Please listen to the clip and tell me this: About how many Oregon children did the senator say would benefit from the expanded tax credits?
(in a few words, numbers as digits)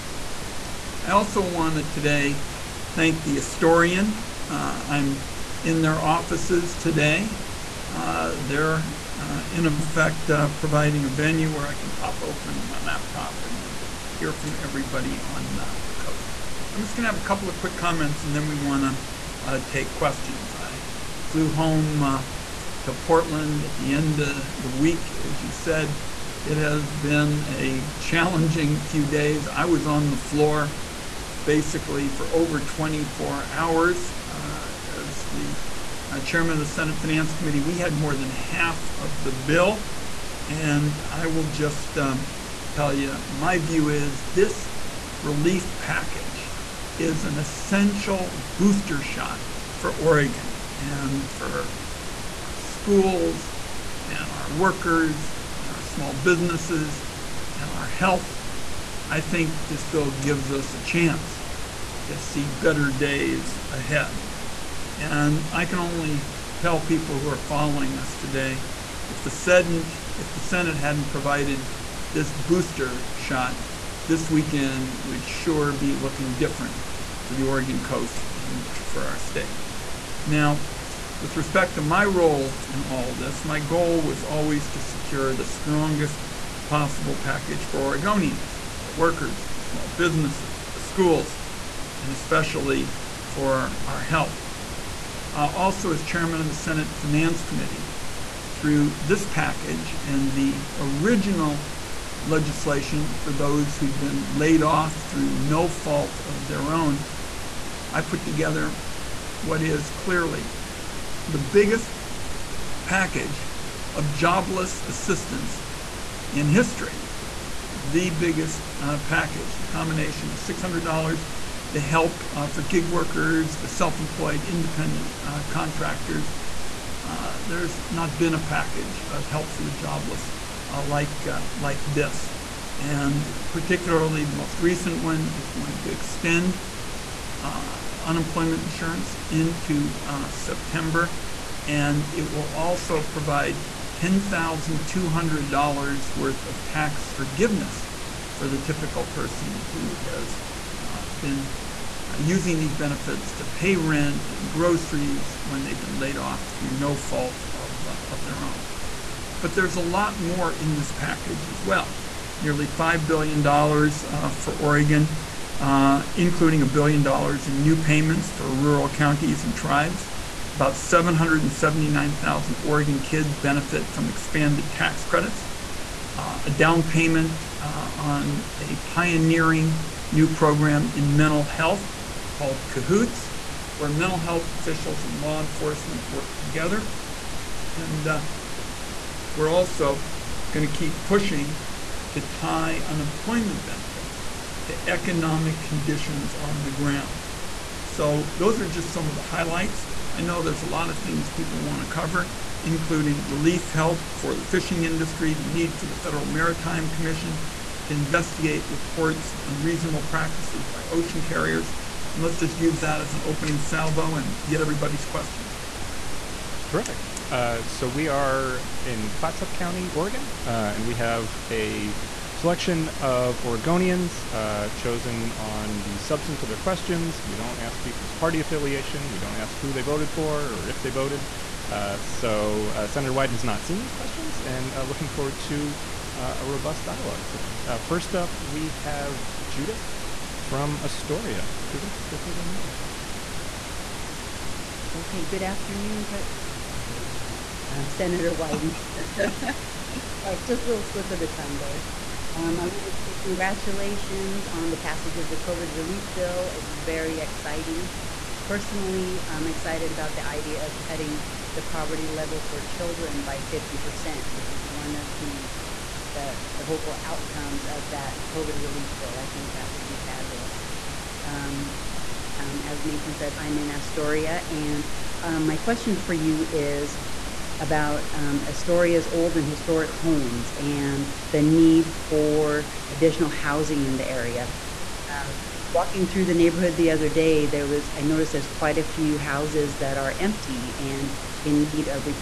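779,000.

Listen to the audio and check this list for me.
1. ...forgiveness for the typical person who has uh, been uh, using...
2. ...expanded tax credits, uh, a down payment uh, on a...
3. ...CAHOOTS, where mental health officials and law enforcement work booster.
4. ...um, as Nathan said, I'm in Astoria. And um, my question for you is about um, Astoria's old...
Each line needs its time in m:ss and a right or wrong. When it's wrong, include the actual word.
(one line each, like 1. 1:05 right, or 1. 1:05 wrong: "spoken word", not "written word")
1. 2:27 right
2. 2:54 right
3. 3:02 wrong: "together", not "booster"
4. 4:32 right.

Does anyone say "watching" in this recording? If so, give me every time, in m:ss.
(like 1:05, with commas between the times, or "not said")
not said.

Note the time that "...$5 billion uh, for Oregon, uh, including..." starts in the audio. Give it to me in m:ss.
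2:42.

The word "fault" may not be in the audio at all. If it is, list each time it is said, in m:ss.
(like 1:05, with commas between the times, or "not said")
1:45, 2:36.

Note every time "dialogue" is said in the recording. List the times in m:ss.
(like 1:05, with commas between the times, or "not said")
3:56.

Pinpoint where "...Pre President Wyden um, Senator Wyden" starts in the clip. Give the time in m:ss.
4:06.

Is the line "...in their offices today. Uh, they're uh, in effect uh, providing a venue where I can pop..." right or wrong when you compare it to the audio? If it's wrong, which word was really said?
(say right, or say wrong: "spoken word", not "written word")
right.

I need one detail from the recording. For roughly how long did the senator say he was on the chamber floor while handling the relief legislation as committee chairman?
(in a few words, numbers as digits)
over 24 hours.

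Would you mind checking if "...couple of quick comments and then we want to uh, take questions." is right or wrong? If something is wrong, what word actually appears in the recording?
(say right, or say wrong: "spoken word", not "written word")
right.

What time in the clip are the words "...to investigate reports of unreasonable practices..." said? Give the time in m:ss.
3:27.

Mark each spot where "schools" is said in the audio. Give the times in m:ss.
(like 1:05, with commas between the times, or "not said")
0:52, 1:30.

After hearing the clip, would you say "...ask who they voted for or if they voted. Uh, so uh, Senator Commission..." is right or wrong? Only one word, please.
wrong.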